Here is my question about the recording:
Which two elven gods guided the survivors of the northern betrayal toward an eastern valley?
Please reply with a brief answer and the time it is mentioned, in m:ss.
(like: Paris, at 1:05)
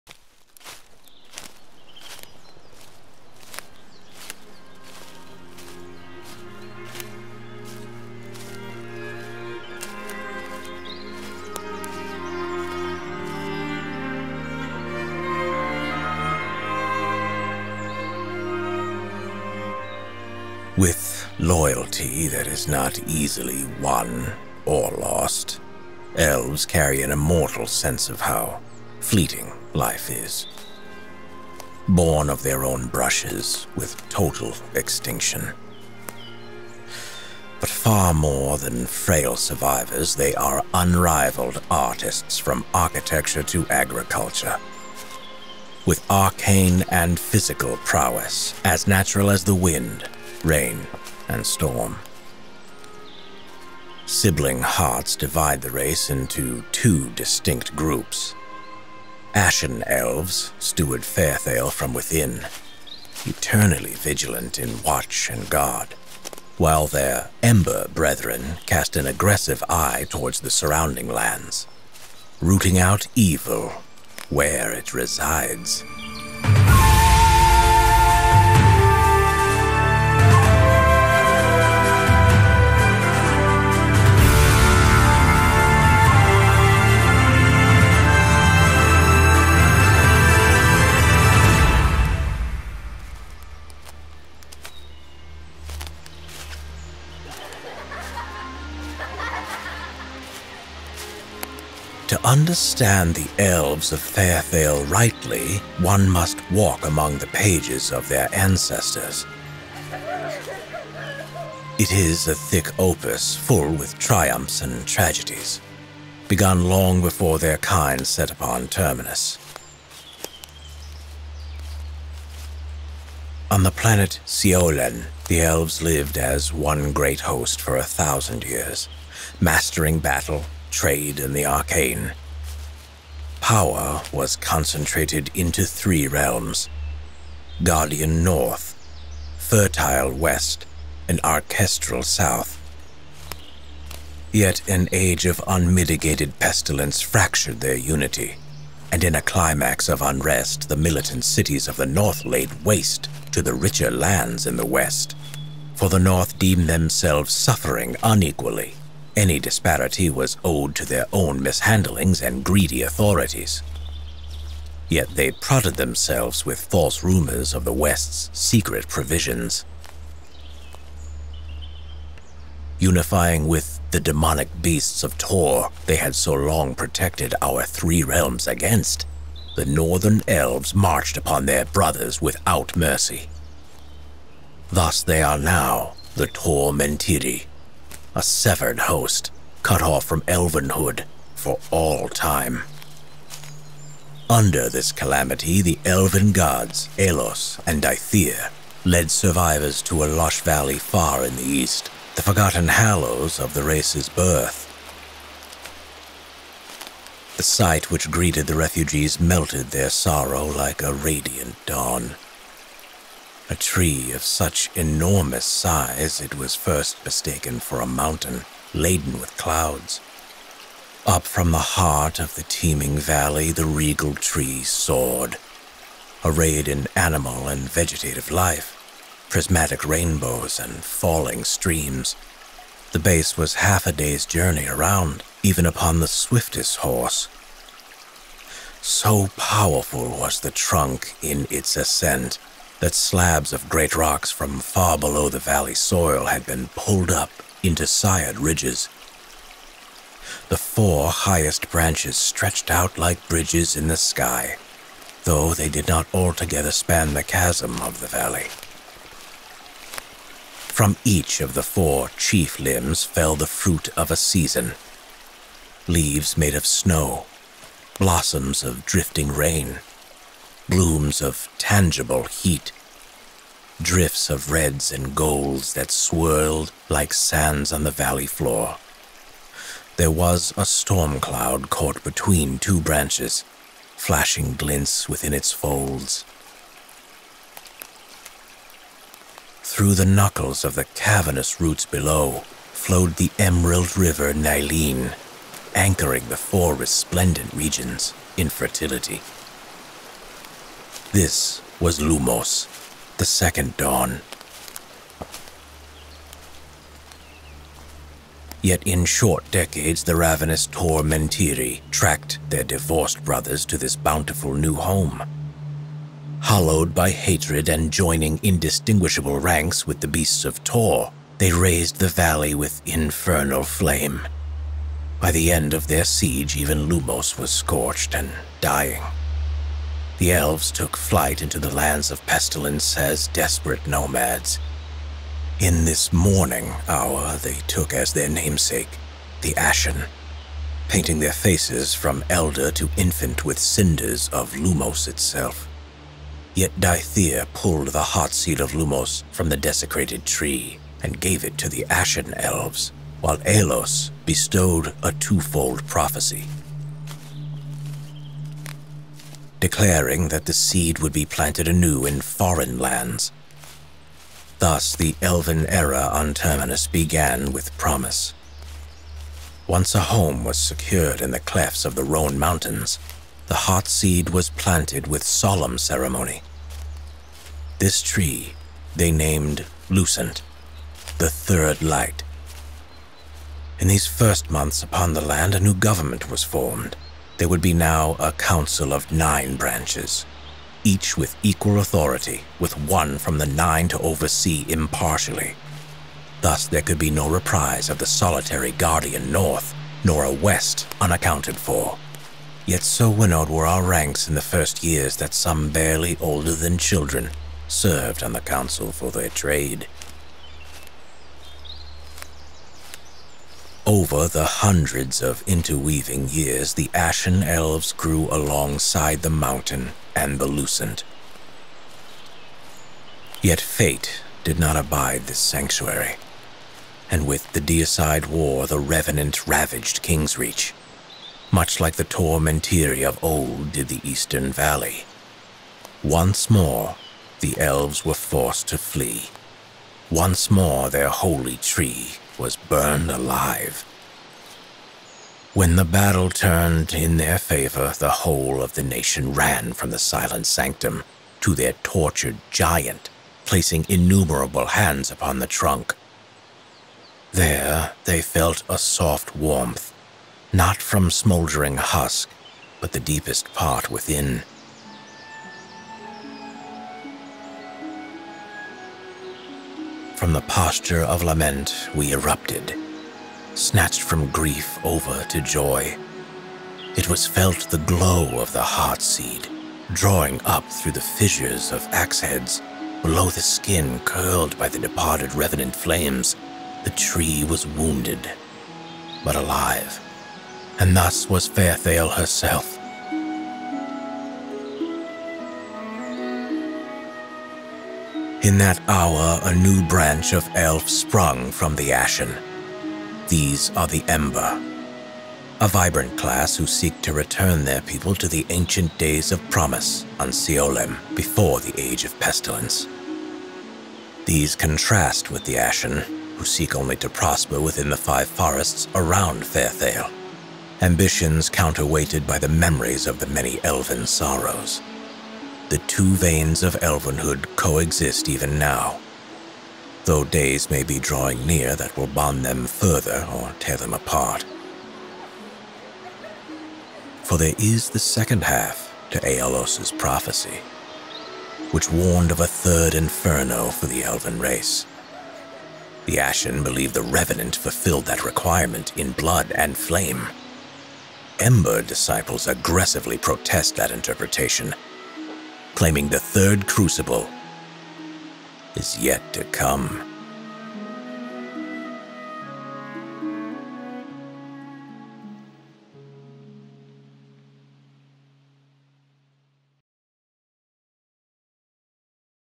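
Elos and Dithea, at 3:16.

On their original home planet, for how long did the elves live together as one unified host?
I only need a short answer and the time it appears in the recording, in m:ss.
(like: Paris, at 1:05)
1000 years, at 2:07.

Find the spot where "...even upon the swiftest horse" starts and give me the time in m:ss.
3:55.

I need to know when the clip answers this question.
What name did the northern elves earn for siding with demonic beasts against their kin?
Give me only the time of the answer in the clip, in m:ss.
3:06.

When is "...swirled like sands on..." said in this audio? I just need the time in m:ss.
4:35.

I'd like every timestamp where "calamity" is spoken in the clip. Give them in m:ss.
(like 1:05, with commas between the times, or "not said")
3:14.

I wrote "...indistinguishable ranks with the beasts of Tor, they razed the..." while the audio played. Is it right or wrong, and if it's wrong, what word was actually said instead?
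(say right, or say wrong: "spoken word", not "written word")
right.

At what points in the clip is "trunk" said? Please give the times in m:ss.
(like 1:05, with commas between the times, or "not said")
4:00, 7:35.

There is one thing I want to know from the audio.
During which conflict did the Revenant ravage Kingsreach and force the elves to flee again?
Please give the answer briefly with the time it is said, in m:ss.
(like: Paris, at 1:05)
Deicide War, at 7:07.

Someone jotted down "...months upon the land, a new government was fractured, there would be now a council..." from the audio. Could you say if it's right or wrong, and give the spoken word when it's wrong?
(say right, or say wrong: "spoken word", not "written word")
wrong: "formed", not "fractured".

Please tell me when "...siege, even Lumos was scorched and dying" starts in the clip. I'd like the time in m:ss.
5:26.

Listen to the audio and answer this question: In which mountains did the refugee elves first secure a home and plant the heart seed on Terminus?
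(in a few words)
Rhone Mountains.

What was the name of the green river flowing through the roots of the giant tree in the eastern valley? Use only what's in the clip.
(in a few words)
Nileen.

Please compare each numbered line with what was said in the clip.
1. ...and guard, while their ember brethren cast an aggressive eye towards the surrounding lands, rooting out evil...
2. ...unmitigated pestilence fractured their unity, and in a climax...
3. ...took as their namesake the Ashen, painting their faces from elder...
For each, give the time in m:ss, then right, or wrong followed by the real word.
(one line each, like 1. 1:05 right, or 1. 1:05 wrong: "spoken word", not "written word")
1. 1:05 right
2. 2:25 right
3. 5:37 right.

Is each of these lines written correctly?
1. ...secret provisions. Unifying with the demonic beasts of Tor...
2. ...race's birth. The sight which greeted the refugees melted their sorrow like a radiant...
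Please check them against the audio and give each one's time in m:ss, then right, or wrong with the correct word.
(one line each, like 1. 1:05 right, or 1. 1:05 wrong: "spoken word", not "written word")
1. 2:48 right
2. 3:23 right.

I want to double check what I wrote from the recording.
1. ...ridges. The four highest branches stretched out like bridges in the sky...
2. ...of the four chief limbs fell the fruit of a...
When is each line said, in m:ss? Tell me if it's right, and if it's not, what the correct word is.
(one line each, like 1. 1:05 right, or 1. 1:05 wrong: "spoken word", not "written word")
1. 4:08 right
2. 4:21 right.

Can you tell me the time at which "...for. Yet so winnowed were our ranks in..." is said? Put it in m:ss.
6:41.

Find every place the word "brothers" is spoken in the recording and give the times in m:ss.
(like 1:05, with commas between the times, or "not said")
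3:01, 5:13.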